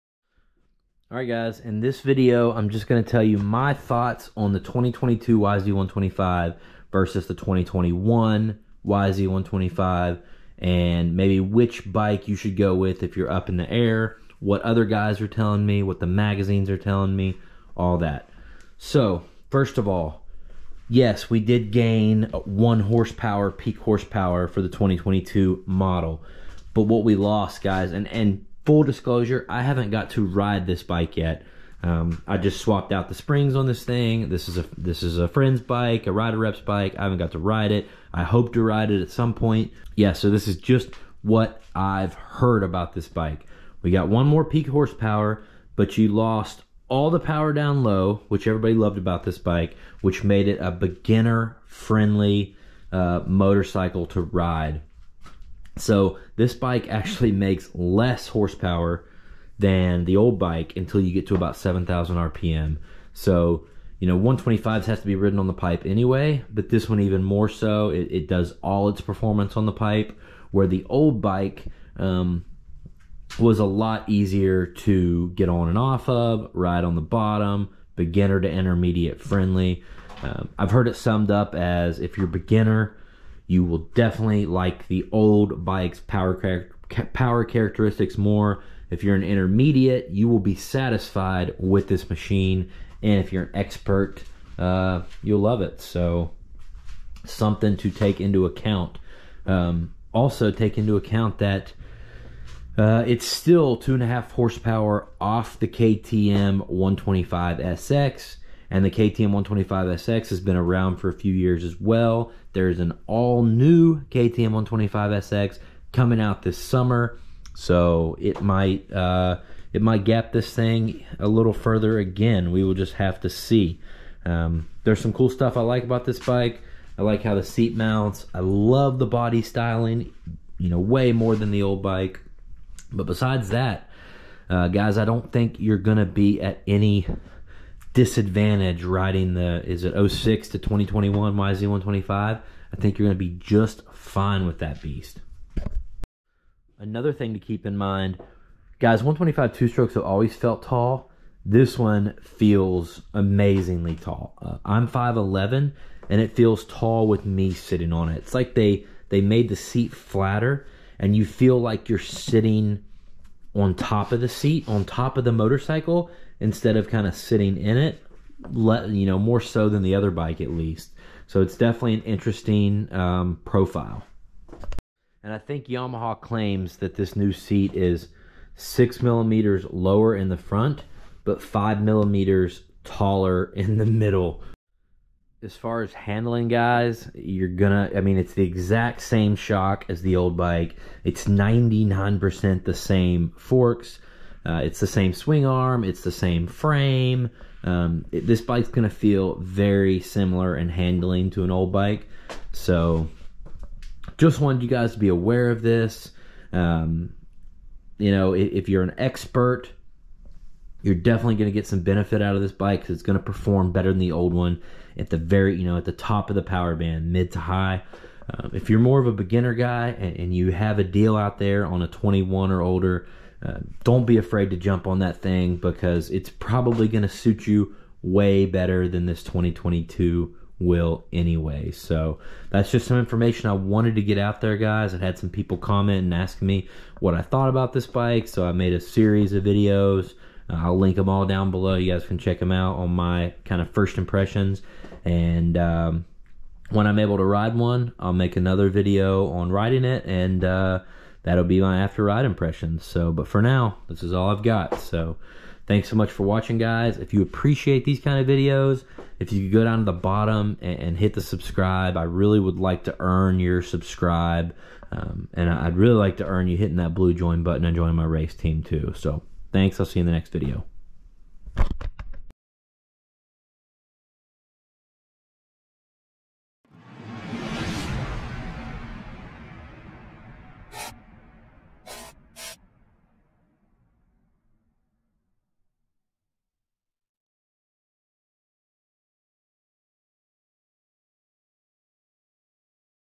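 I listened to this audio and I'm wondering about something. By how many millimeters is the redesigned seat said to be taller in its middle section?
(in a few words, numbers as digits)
5 millimeters.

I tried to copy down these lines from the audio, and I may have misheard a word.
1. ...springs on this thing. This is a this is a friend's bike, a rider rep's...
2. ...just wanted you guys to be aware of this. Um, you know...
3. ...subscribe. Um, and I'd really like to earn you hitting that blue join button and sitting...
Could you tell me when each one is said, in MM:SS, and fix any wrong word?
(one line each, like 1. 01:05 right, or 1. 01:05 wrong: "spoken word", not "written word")
1. 00:33 right
2. 03:24 right
3. 04:23 wrong: "joining", not "sitting".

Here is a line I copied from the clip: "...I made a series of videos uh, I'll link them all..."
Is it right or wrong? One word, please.
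right.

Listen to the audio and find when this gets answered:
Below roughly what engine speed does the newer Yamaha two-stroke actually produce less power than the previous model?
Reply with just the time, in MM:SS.
01:01.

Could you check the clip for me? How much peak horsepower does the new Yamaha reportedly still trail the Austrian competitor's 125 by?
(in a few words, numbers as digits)
2.5 horsepower.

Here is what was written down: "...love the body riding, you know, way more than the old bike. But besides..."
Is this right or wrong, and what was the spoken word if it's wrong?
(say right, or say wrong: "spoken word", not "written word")
wrong: "styling", not "riding".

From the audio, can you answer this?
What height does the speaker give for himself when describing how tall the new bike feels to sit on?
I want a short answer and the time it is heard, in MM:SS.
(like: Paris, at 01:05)
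5'11, at 02:34.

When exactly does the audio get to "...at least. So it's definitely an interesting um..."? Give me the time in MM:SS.
02:50.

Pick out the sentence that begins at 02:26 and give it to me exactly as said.
Another thing to keep in mind, guys, 125 two strokes have always felt tall.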